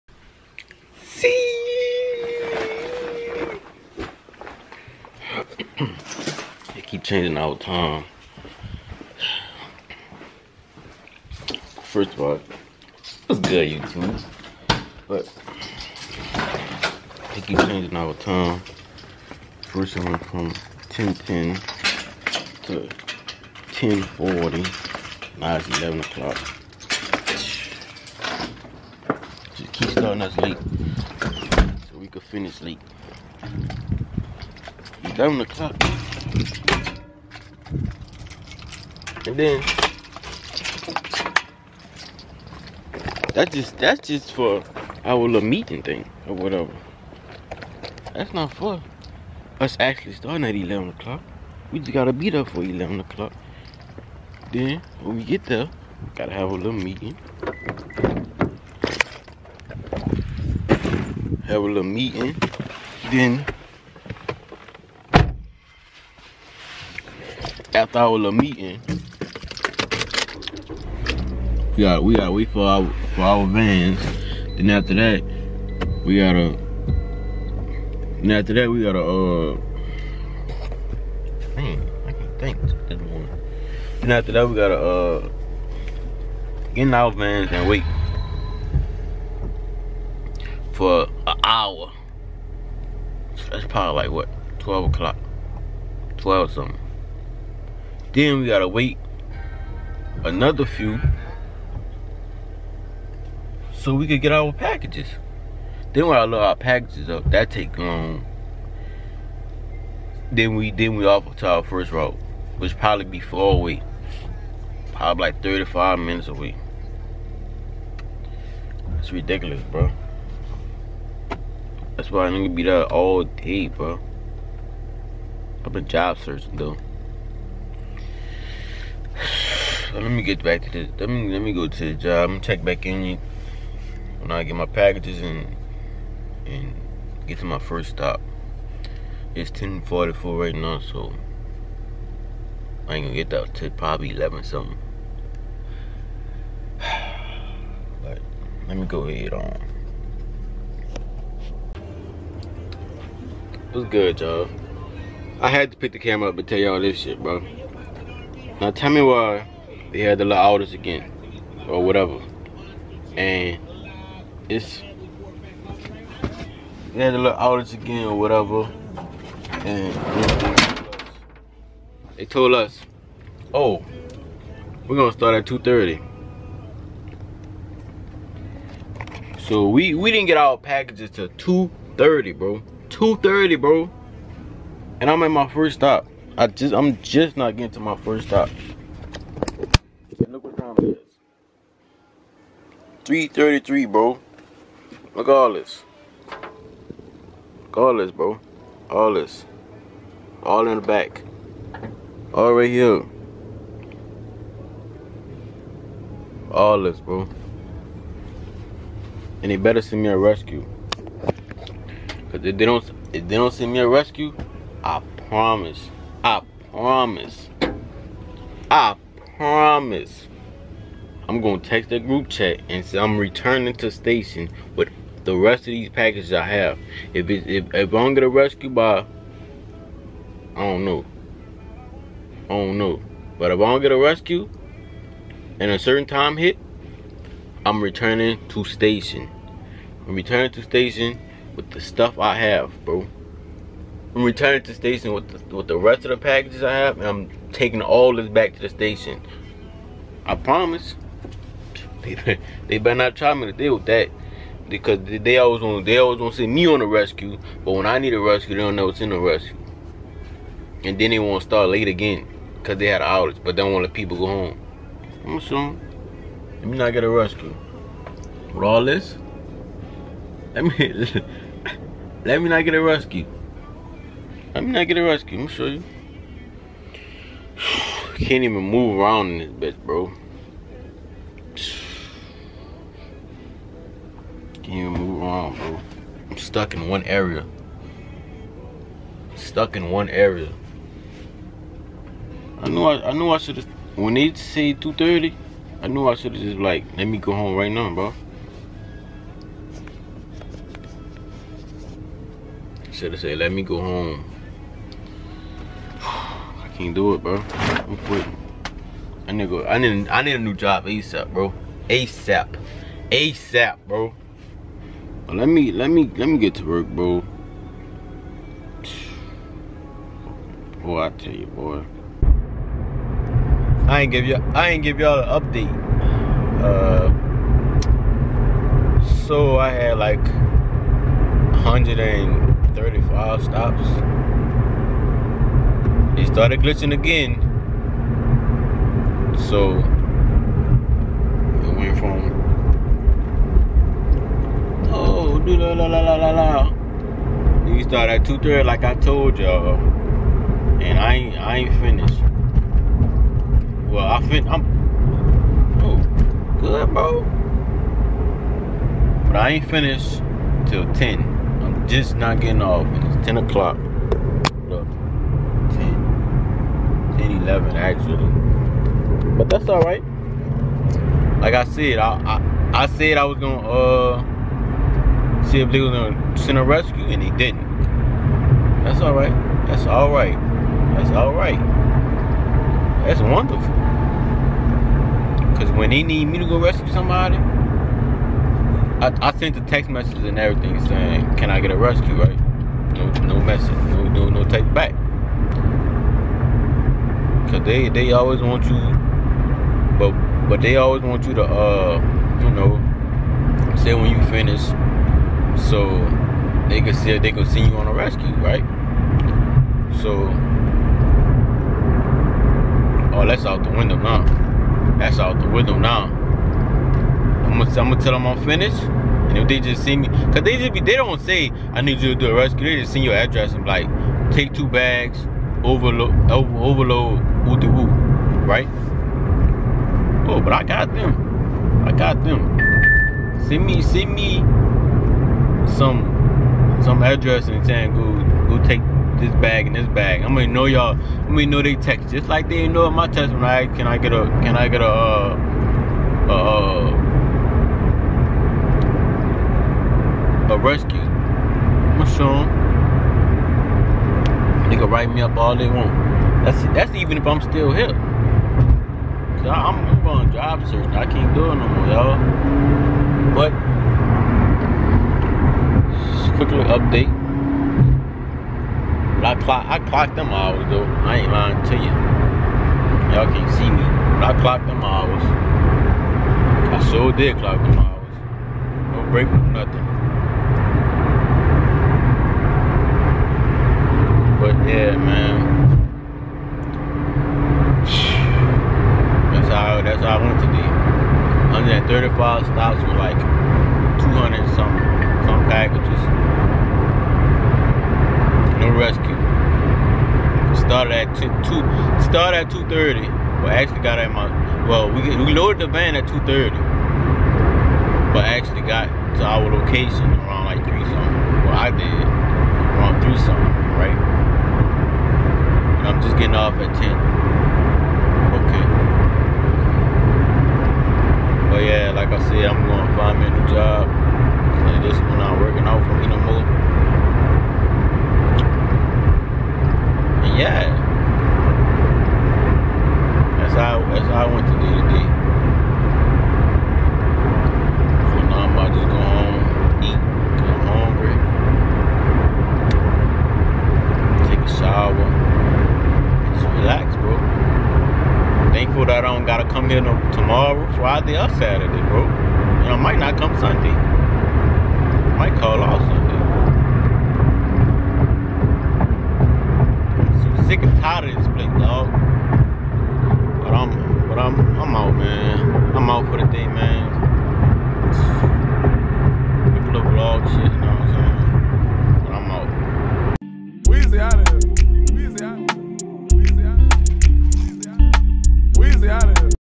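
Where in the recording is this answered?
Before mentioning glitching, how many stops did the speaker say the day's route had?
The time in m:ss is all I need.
5:31.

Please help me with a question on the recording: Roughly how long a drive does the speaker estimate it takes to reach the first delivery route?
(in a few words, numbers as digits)
35 minutes.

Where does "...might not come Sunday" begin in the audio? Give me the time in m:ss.
9:12.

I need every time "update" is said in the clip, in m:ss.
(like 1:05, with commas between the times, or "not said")
5:25, 7:46.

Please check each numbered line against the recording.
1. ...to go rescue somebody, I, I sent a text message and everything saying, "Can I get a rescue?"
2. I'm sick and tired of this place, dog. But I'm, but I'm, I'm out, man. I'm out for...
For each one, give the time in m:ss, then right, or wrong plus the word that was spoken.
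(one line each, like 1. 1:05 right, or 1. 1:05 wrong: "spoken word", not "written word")
1. 6:26 right
2. 9:20 right.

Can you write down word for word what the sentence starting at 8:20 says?
Started at two, two started at 230.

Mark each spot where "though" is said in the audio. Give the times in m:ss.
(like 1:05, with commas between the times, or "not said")
2:06, 7:50.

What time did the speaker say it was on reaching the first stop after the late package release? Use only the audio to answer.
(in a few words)
3:33.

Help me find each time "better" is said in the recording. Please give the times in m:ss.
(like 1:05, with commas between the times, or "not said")
3:29, 4:12.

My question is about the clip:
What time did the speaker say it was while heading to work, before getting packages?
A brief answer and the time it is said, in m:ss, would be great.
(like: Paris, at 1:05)
10:44, at 2:19.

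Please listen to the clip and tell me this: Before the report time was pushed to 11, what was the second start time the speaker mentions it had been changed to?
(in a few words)
10:40.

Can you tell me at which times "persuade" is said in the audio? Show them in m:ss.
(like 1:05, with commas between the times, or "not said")
not said.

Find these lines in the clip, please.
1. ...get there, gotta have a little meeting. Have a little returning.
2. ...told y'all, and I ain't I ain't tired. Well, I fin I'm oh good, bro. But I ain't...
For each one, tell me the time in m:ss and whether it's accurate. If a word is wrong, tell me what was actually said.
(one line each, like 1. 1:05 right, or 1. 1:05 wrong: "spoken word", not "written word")
1. 0:55 wrong: "meeting", not "returning"
2. 5:48 wrong: "finished", not "tired".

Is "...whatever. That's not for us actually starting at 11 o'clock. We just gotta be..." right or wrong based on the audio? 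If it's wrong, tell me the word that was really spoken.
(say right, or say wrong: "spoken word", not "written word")
right.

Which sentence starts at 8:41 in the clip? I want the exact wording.
yeah, like I said, I'm gonna find me a new job.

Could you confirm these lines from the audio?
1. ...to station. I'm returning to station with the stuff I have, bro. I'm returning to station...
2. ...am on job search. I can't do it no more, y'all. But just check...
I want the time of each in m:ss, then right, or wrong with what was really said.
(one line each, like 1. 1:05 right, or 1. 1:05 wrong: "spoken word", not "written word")
1. 3:58 right
2. 7:39 wrong: "quick", not "check".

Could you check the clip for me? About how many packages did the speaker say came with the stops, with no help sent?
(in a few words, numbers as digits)
200.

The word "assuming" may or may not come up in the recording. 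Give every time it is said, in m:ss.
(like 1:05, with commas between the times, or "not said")
4:25.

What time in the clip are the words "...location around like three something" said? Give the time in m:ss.
8:29.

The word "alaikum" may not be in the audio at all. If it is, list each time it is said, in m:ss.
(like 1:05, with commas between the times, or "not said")
not said.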